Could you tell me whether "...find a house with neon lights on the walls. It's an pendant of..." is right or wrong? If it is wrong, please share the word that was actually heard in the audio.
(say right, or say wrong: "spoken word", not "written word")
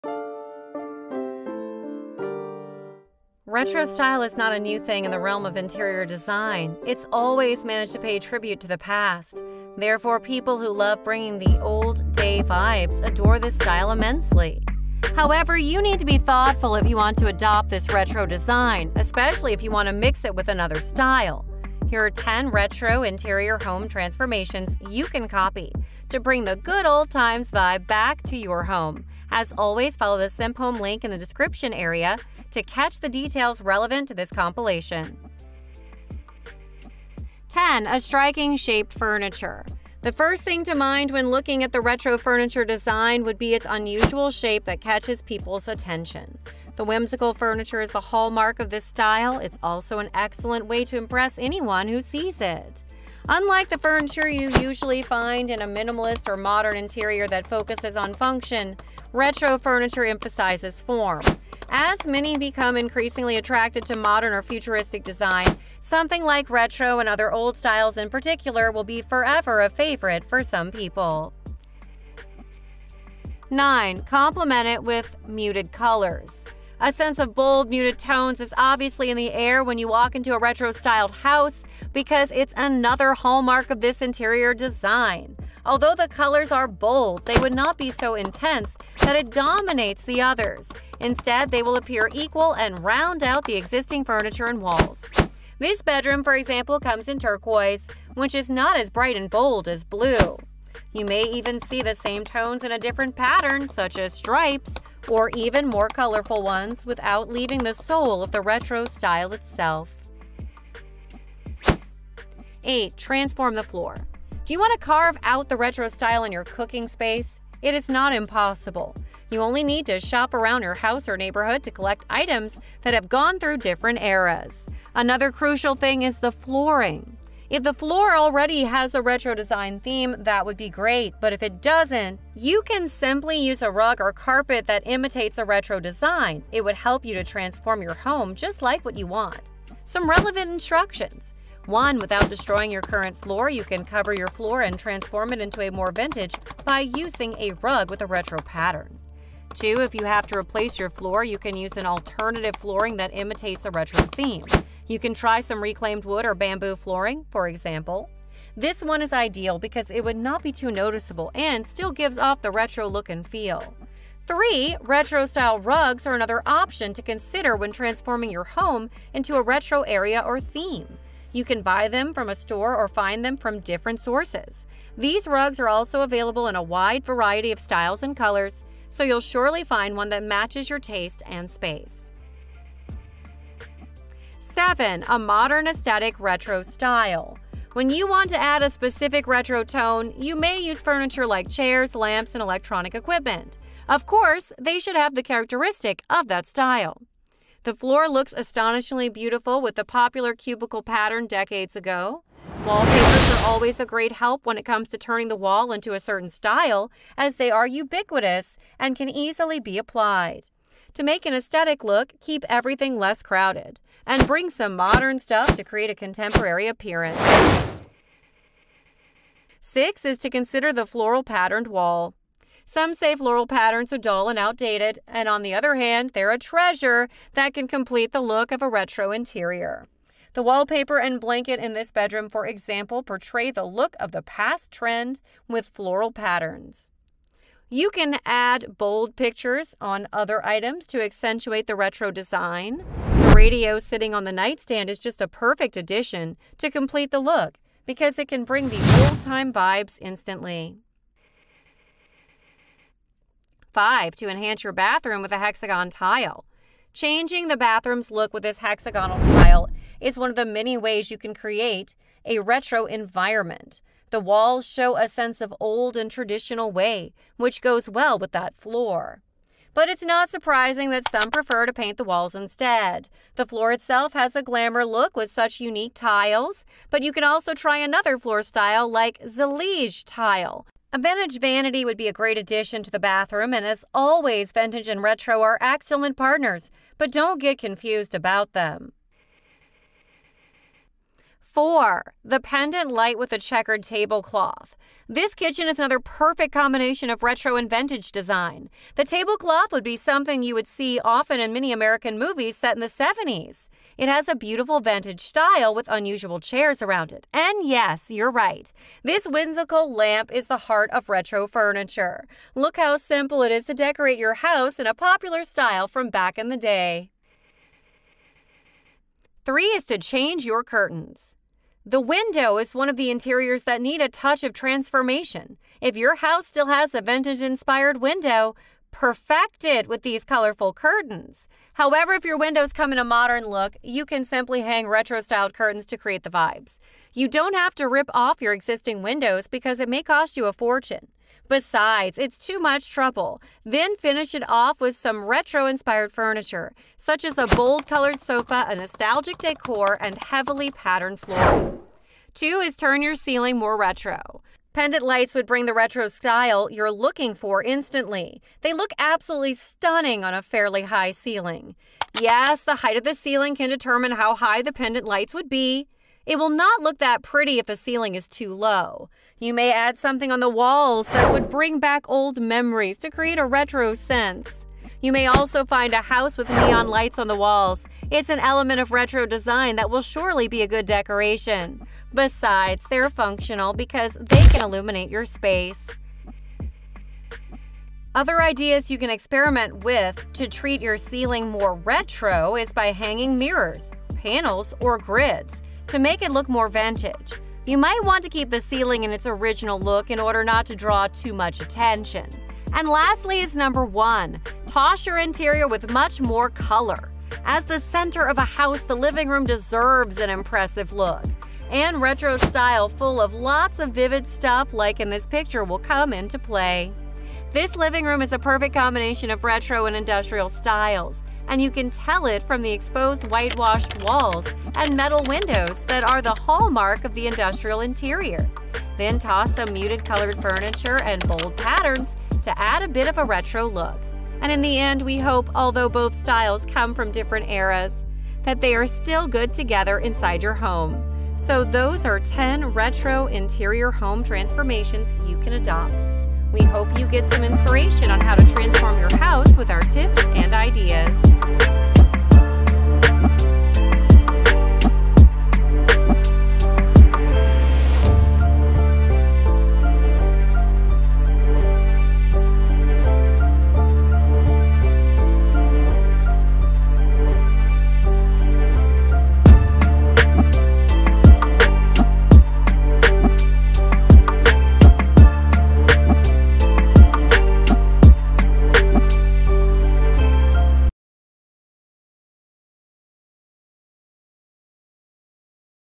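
wrong: "element", not "pendant".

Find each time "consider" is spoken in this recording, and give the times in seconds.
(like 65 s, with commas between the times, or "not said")
167 s, 220 s.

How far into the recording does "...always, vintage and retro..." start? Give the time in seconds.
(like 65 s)
283 s.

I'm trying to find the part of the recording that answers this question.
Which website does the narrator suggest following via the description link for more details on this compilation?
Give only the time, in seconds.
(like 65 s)
30 s.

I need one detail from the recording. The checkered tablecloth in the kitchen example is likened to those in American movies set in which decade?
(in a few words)
The 70s.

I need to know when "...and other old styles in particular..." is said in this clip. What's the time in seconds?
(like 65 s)
66 s.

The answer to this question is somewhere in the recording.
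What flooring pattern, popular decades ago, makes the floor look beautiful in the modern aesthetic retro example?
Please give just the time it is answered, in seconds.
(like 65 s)
200 s.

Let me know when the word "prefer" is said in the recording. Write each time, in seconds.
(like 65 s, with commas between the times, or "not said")
271 s.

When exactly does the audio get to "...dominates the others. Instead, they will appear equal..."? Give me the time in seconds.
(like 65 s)
89 s.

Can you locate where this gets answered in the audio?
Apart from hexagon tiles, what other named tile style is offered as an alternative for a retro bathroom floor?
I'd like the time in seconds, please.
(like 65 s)
279 s.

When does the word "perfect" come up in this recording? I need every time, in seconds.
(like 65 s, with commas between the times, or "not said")
245 s, 295 s, 328 s, 418 s.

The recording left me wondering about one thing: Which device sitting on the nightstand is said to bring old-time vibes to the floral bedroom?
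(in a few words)
Radio.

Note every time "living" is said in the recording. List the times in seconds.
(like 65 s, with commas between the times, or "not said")
408 s, 417 s.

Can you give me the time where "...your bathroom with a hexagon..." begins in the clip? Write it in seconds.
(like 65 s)
254 s.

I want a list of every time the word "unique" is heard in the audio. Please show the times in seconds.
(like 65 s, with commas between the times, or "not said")
275 s.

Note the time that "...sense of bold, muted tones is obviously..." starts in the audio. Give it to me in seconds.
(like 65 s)
76 s.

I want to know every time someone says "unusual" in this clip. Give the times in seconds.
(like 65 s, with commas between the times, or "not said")
43 s, 305 s.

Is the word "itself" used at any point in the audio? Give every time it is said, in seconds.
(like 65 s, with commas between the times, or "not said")
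109 s, 273 s.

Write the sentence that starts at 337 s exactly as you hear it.
You don't have to rip off your existing windows because it may cost you a fortune.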